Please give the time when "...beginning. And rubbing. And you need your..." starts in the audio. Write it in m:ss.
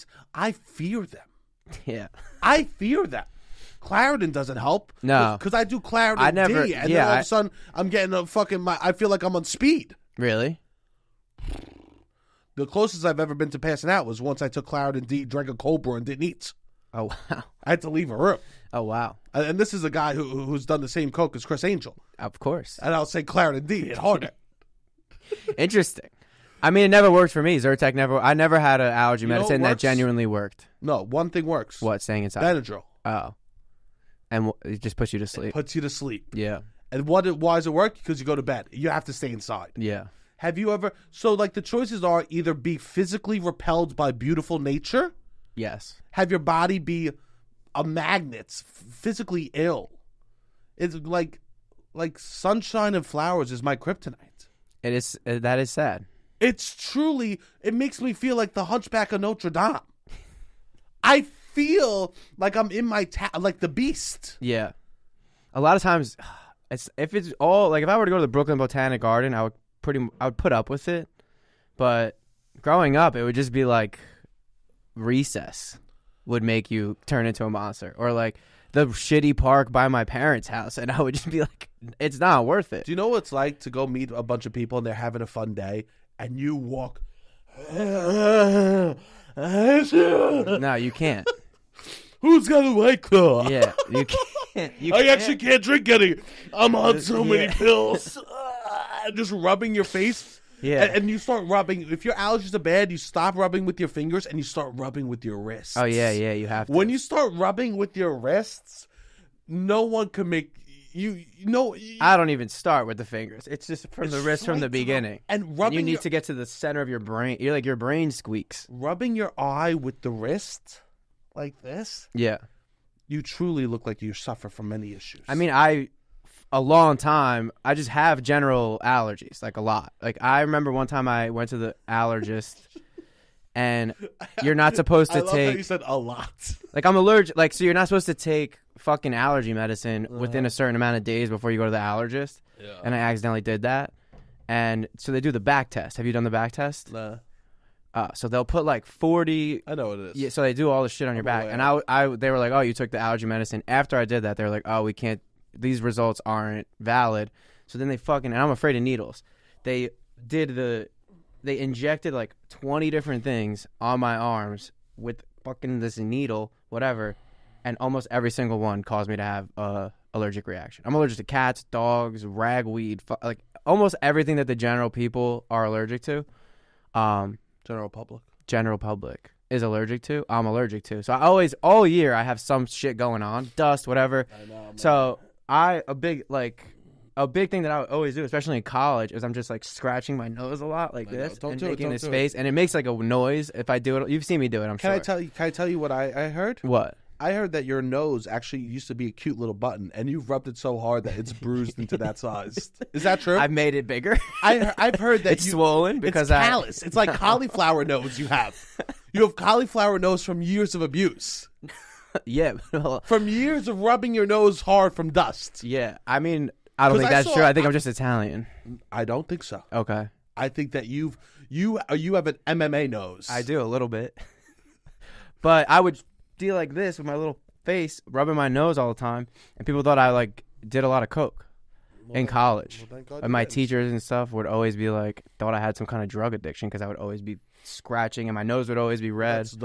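1:54.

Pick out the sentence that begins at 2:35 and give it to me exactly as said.
These results aren't valid." So then they fucking.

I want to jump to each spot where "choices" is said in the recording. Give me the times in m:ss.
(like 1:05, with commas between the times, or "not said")
0:41.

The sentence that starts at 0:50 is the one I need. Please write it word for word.
It's like like sunshine and flowers is my kryptonite.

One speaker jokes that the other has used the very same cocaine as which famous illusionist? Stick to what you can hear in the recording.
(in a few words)
Criss Angel.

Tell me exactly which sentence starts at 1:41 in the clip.
If your allergies are bad, you stop rubbing with your fingers and you start rubbing with your wrists.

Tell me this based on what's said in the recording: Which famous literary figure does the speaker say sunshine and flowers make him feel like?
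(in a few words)
The Hunchback of Notre Dame.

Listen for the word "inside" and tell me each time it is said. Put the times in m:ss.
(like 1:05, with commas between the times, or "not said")
0:32, 0:39.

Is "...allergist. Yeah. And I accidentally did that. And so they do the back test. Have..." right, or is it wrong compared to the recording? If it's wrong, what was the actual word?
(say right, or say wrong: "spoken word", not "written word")
right.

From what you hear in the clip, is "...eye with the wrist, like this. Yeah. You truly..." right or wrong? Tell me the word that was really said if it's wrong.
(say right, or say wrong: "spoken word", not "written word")
right.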